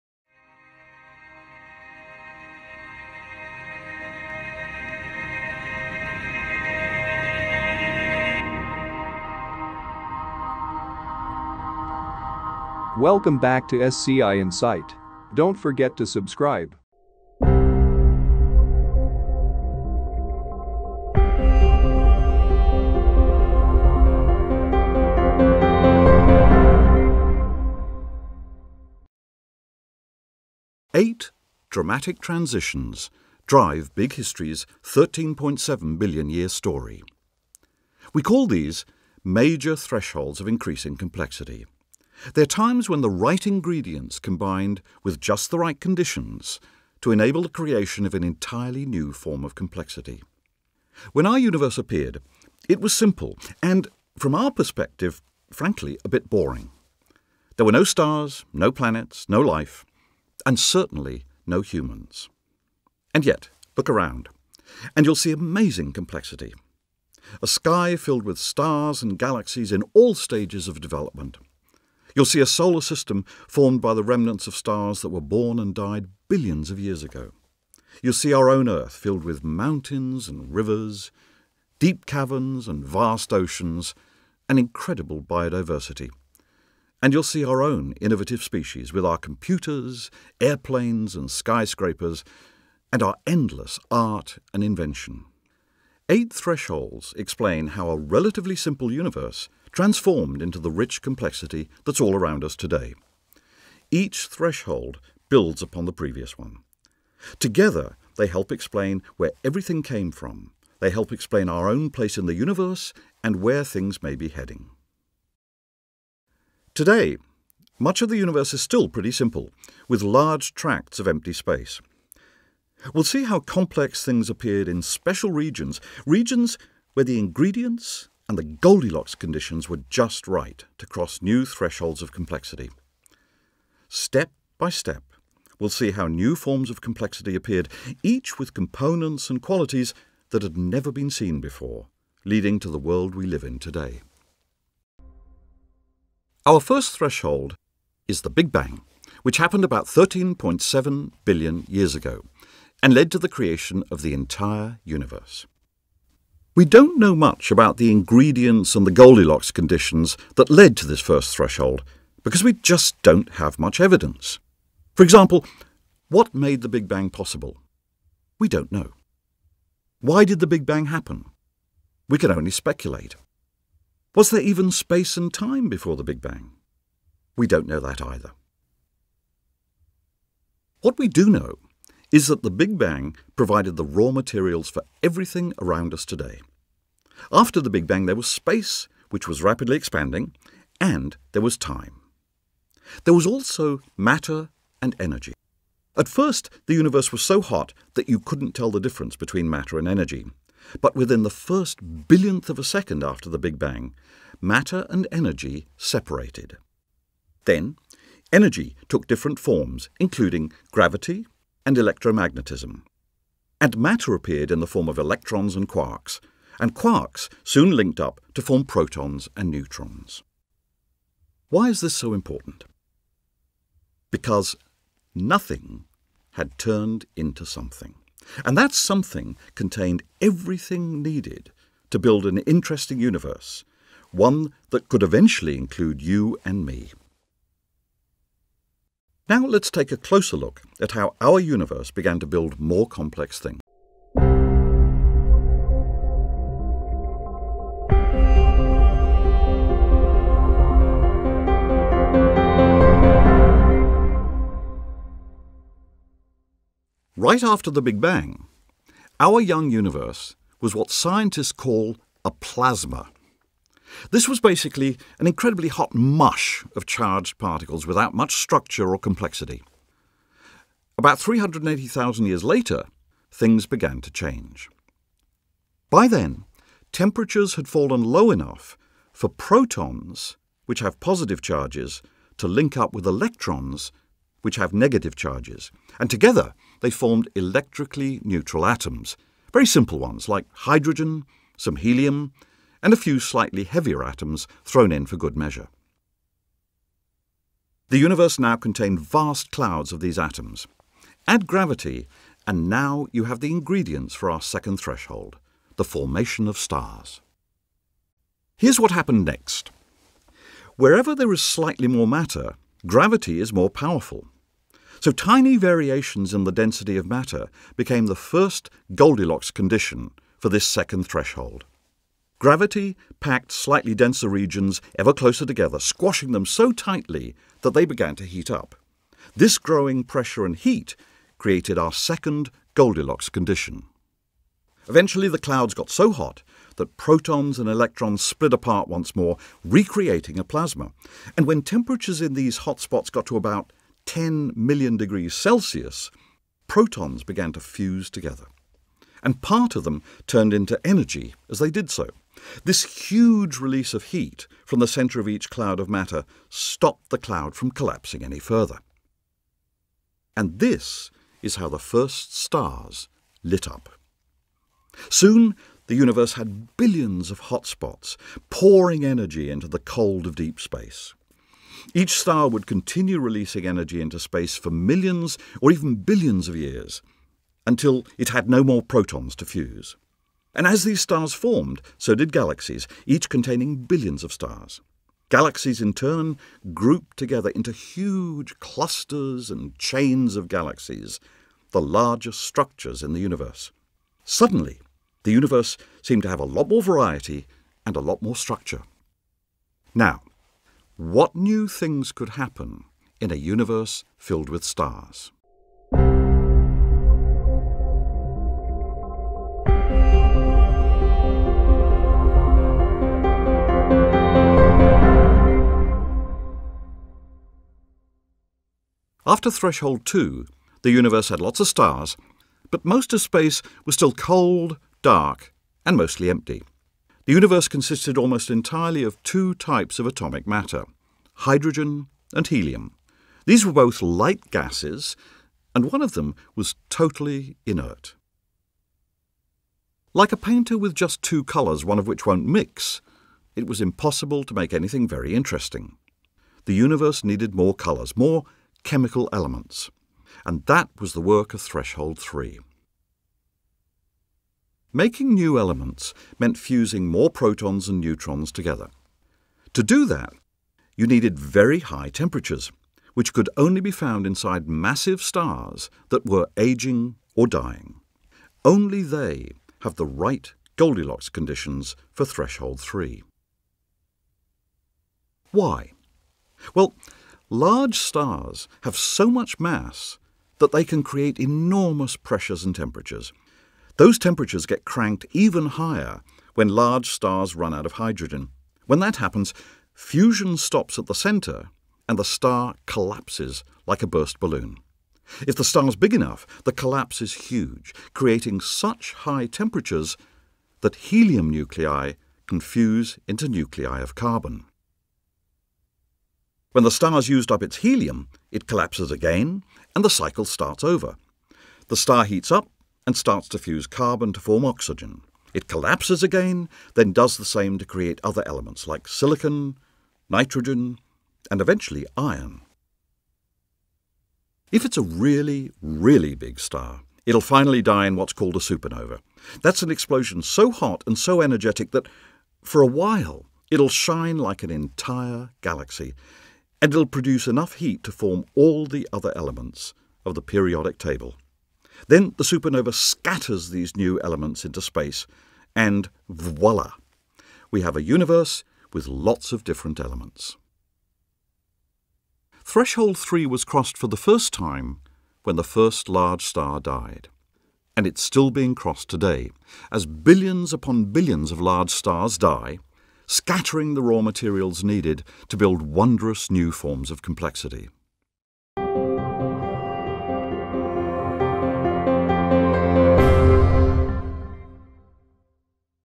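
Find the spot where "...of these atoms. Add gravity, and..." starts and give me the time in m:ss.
4:59.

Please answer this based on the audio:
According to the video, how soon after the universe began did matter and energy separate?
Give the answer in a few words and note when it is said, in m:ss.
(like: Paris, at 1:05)
first billionth of a second, at 3:21.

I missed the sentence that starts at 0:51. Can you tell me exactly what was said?
When our universe appeared, it was simple and, from our perspective, frankly, a bit boring.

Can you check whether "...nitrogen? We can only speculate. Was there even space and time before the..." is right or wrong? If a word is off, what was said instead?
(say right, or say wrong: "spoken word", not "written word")
wrong: "happen", not "nitrogen".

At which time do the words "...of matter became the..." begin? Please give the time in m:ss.
5:16.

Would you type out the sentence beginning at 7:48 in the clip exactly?
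Only they have the right Goldilocks conditions for threshold 3.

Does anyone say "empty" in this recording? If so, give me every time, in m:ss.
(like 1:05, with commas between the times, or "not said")
2:01, 7:06.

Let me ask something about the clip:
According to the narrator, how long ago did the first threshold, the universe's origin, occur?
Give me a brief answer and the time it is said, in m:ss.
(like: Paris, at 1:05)
13.7 billion years, at 2:29.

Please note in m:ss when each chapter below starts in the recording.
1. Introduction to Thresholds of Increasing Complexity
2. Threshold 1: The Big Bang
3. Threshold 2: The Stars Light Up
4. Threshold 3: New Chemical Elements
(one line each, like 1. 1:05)
1. 0:18
2. 2:25
3. 4:03
4. 6:48.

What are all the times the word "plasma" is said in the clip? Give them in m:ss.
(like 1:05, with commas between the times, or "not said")
4:22, 5:40.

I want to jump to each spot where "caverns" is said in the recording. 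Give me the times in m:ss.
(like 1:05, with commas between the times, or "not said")
1:22.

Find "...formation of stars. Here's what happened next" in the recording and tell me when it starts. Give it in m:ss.
5:05.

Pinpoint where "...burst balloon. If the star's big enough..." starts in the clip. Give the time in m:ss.
8:14.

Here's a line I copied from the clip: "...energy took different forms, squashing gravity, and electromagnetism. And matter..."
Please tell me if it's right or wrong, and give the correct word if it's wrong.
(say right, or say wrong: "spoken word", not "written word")
wrong: "including", not "squashing".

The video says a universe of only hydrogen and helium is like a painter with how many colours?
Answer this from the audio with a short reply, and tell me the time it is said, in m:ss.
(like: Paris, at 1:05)
2, at 7:21.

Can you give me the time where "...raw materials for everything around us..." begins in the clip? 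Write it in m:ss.
3:03.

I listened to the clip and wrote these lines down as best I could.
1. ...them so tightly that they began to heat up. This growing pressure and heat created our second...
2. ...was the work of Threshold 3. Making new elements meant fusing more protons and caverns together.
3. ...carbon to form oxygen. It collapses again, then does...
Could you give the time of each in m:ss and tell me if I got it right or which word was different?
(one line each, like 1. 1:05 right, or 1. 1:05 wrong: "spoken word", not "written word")
1. 5:26 right
2. 7:30 wrong: "neutrons", not "caverns"
3. 8:33 right.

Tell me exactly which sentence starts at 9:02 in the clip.
Then the supernova scatters these new elements into space, and voila!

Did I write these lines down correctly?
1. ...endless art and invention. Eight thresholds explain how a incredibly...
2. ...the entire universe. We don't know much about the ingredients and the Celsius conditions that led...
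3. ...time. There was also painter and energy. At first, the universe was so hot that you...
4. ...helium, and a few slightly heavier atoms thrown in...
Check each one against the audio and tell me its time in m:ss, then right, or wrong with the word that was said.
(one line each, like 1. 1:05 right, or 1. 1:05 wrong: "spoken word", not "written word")
1. 1:33 wrong: "relatively", not "incredibly"
2. 2:34 wrong: "Goldilocks", not "Celsius"
3. 3:11 wrong: "matter", not "painter"
4. 4:51 right.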